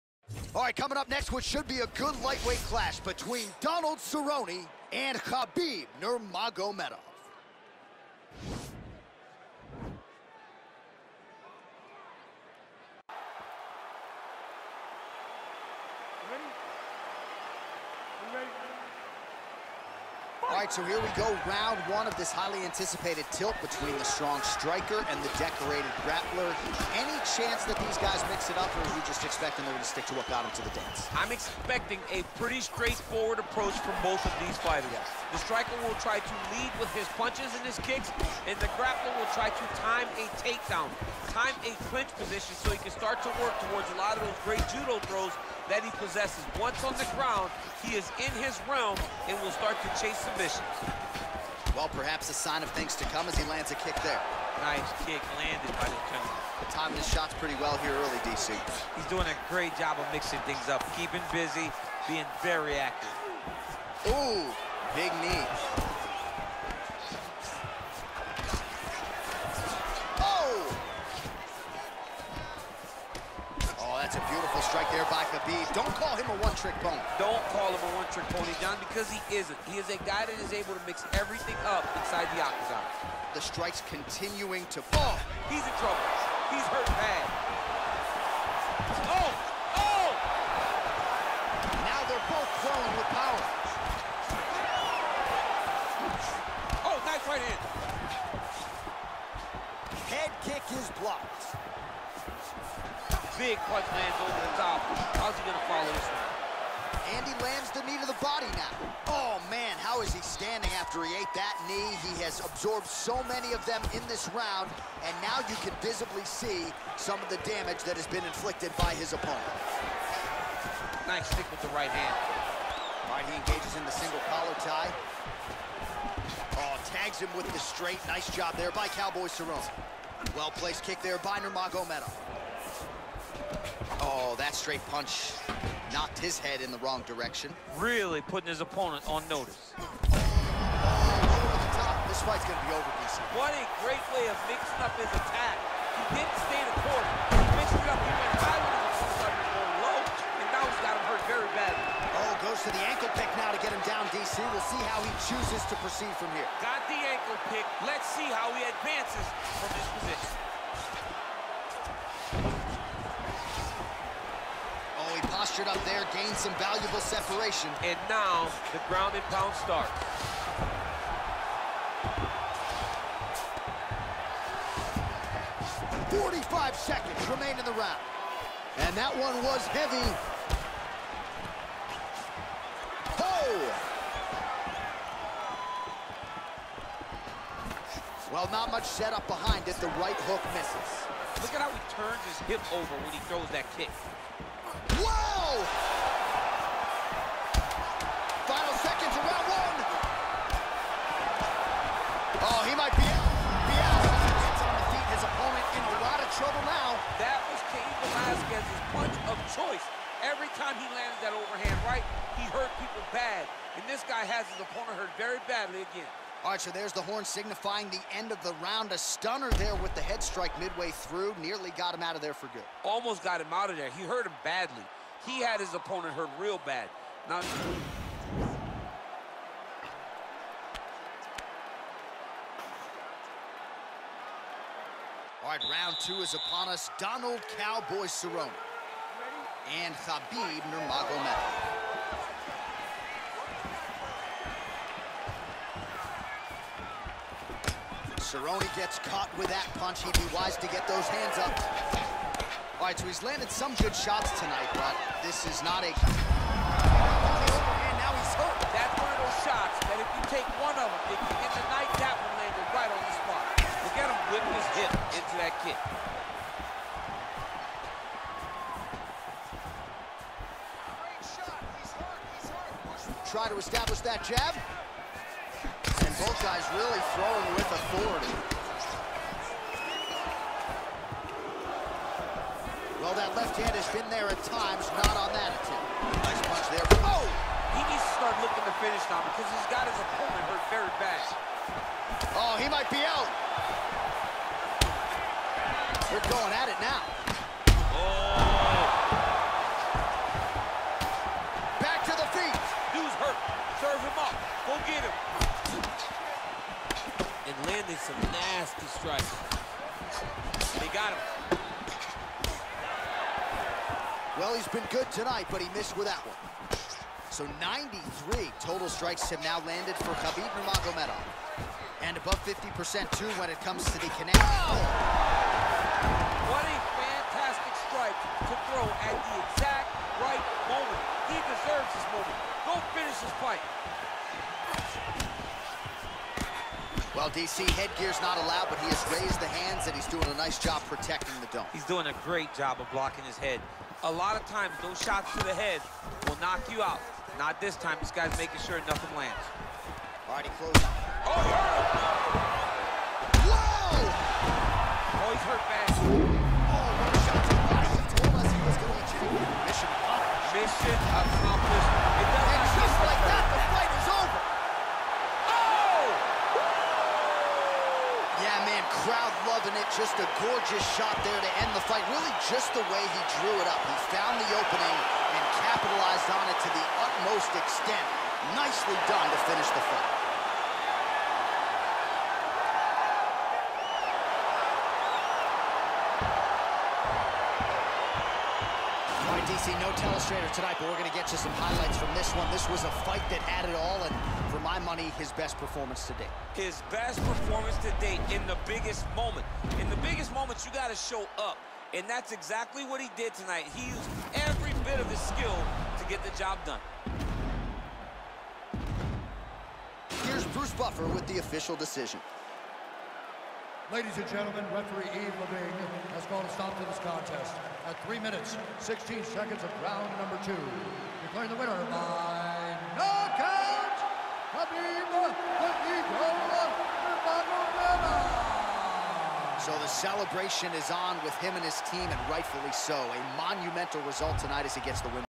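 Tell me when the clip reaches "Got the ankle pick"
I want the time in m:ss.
2:36.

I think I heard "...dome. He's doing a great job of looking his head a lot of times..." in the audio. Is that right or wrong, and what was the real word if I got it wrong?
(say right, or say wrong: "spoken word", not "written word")
wrong: "blocking", not "looking".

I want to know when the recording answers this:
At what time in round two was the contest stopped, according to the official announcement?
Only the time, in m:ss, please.
6:58.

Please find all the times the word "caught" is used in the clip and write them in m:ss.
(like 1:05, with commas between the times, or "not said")
4:08.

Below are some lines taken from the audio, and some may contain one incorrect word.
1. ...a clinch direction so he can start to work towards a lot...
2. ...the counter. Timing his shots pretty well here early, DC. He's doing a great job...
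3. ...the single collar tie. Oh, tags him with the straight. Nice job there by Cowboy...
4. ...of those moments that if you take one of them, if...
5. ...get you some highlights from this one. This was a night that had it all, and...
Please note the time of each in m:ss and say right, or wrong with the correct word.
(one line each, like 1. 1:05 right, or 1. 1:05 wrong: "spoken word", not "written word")
1. 0:41 wrong: "position", not "direction"
2. 0:55 right
3. 2:03 right
4. 4:19 wrong: "shots", not "moments"
5. 6:31 wrong: "fight", not "night".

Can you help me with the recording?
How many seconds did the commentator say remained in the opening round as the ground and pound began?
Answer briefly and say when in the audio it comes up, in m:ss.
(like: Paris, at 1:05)
45, at 2:56.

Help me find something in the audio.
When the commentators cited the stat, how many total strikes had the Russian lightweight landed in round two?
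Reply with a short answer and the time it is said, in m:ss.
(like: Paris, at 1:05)
93, at 5:17.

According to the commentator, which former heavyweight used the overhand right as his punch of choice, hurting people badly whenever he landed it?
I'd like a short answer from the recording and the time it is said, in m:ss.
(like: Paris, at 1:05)
Cain Velasquez, at 3:27.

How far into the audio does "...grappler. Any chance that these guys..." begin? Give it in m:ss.
0:26.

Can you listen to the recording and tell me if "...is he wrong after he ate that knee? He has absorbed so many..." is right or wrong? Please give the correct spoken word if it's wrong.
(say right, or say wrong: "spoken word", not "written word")
wrong: "standing", not "wrong".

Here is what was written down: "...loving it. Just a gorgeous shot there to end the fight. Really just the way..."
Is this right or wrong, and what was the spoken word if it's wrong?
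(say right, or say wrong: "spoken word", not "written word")
right.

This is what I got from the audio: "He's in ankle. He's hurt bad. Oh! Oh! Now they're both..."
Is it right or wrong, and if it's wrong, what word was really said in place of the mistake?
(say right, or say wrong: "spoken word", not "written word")
wrong: "trouble", not "ankle".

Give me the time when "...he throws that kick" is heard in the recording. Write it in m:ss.
3:13.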